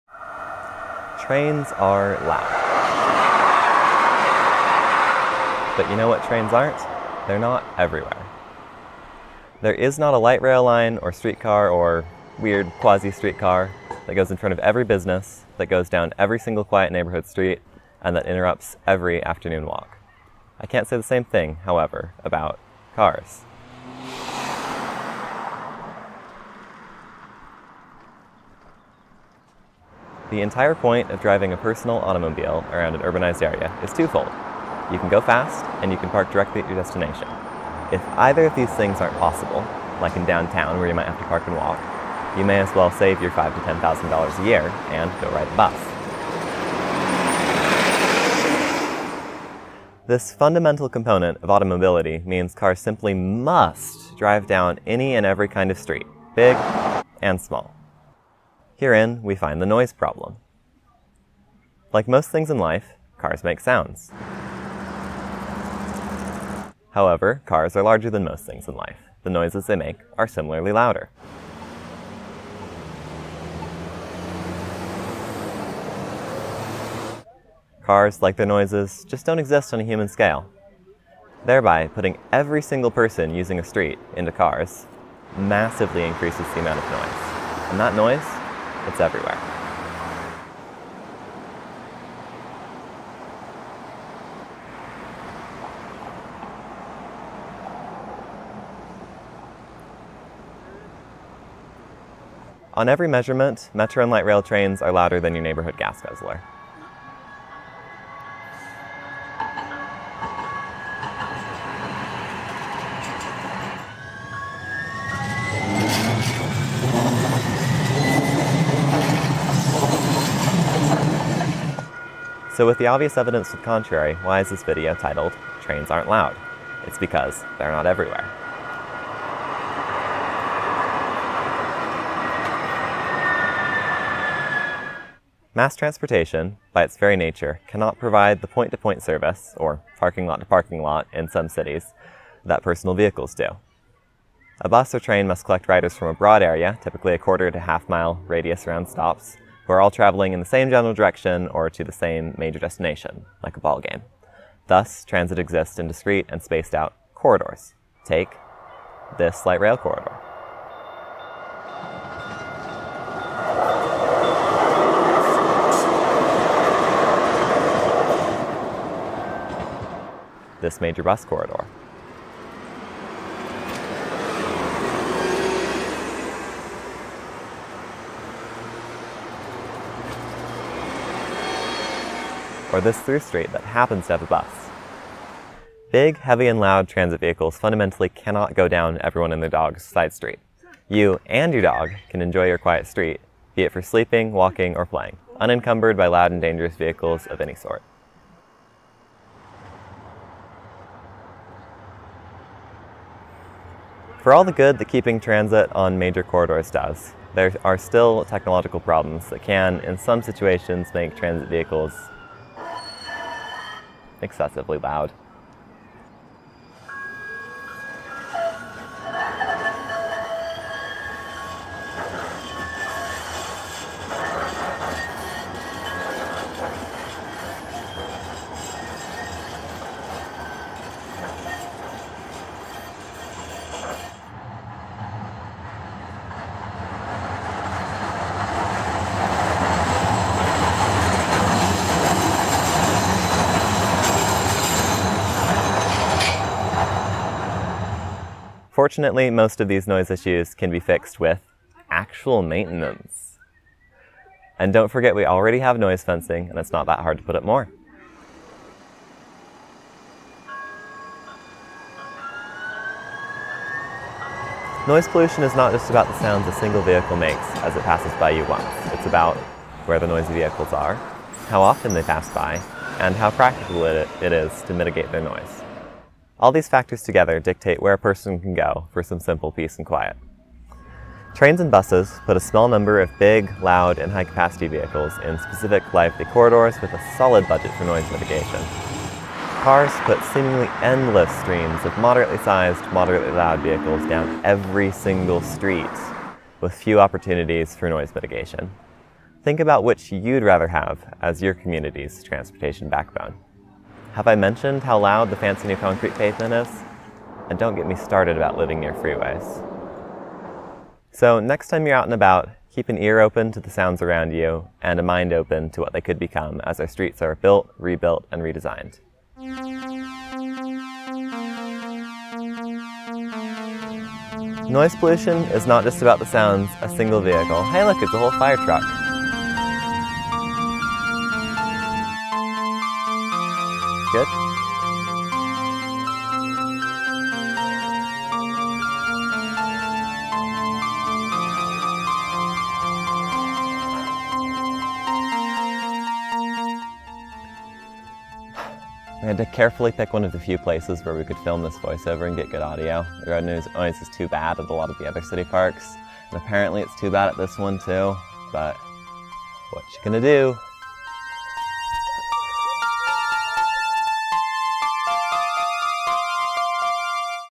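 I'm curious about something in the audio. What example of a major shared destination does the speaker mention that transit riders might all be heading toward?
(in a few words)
A ball game.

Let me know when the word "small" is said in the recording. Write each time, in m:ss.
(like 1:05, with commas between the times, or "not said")
0:57, 4:42.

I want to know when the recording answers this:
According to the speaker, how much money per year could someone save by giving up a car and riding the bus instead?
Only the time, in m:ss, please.
0:43.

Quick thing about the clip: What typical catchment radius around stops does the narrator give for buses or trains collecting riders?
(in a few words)
Quarter to half mile.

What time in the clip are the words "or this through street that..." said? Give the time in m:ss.
3:02.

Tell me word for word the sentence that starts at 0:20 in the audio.
I can't say the same thing, however, about cars.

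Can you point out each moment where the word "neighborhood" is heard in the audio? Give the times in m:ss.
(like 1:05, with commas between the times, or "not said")
0:16, 1:45.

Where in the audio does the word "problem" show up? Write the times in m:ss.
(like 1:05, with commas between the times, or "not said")
0:59, 3:28.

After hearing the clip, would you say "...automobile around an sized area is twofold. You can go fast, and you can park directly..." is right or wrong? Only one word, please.
wrong.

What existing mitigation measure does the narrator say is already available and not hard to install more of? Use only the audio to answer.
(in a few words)
Noise fencing.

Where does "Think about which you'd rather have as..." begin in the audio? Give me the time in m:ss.
4:59.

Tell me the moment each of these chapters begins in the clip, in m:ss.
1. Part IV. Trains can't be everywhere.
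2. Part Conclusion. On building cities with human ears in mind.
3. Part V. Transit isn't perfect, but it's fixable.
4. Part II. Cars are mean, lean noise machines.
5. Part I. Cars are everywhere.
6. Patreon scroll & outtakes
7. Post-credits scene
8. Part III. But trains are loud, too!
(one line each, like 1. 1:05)
1. 2:08
2. 4:19
3. 3:20
4. 0:59
5. 0:26
6. 5:19
7. 5:47
8. 1:39.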